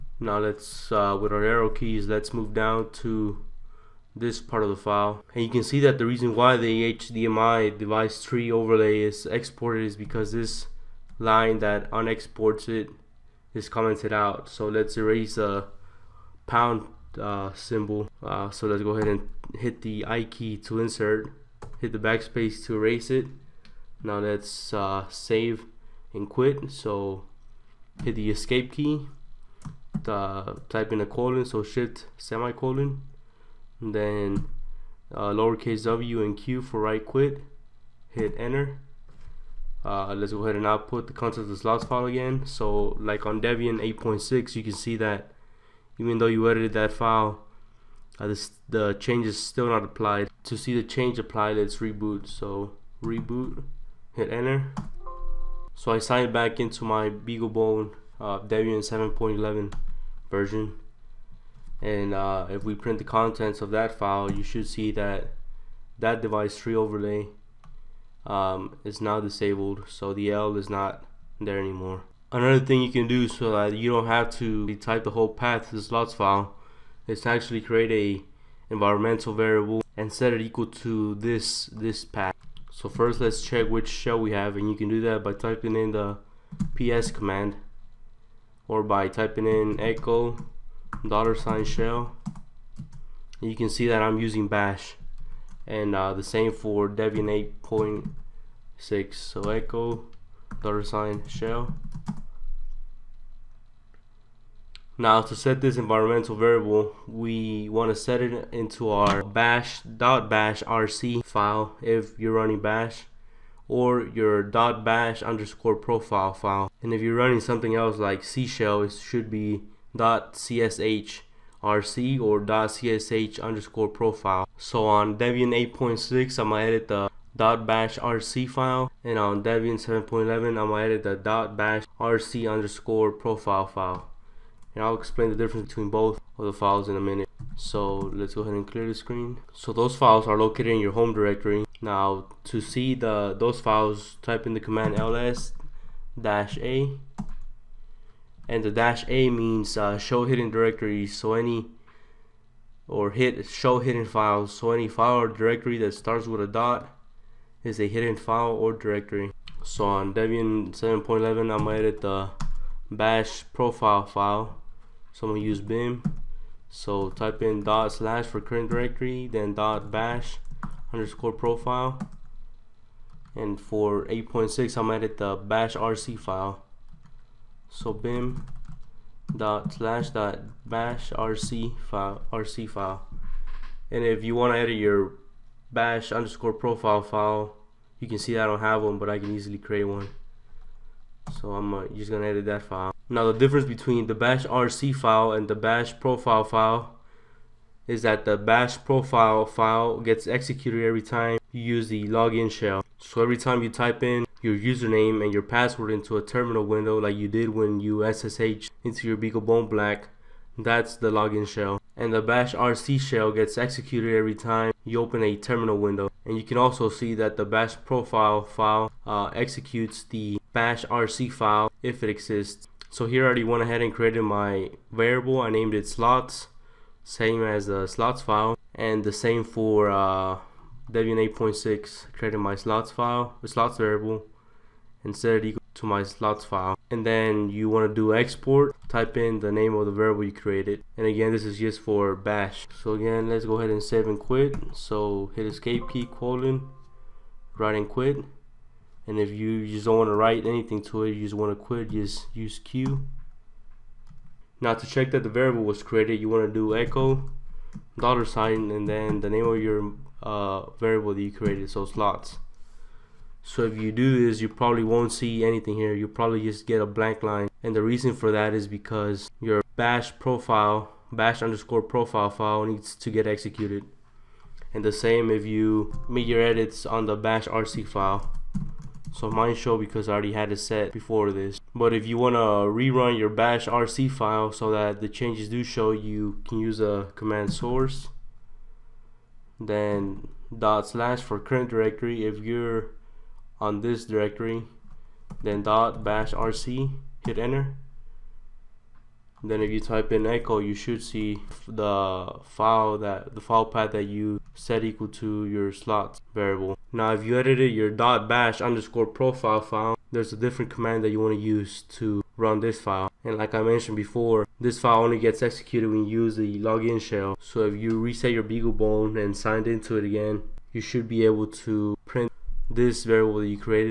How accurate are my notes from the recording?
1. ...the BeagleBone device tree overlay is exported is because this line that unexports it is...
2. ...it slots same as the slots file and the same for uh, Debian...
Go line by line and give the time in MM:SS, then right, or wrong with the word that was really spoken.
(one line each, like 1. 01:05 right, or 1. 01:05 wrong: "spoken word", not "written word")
1. 00:06 wrong: "HDMI", not "BeagleBone"
2. 03:45 right.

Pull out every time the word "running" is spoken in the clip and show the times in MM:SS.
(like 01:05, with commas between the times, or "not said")
01:52, 01:57.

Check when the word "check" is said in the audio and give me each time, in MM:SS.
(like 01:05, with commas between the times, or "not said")
01:23, 04:14.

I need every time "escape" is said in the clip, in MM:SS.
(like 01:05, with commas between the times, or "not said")
00:28, 04:05.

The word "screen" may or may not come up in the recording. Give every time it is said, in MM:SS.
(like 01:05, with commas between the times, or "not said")
02:18.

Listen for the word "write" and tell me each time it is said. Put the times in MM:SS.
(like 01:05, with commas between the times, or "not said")
04:10.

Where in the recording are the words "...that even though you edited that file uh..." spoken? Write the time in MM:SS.
00:44.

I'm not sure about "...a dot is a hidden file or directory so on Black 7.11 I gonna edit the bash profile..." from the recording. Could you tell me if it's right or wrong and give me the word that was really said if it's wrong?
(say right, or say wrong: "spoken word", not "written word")
wrong: "Debian", not "Black".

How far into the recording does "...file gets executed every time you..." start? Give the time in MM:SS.
03:19.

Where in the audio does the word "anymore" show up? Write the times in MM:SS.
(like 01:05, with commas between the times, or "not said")
01:11.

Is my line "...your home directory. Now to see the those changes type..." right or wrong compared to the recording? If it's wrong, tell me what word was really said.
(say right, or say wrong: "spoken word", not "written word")
wrong: "files", not "changes".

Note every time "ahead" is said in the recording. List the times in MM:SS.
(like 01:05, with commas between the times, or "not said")
00:18, 00:40, 02:18, 03:43, 04:03.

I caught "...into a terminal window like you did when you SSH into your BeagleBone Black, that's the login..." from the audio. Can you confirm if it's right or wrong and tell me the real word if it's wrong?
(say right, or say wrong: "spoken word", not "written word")
right.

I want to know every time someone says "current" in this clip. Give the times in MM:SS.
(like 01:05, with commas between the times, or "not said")
02:48, 04:51.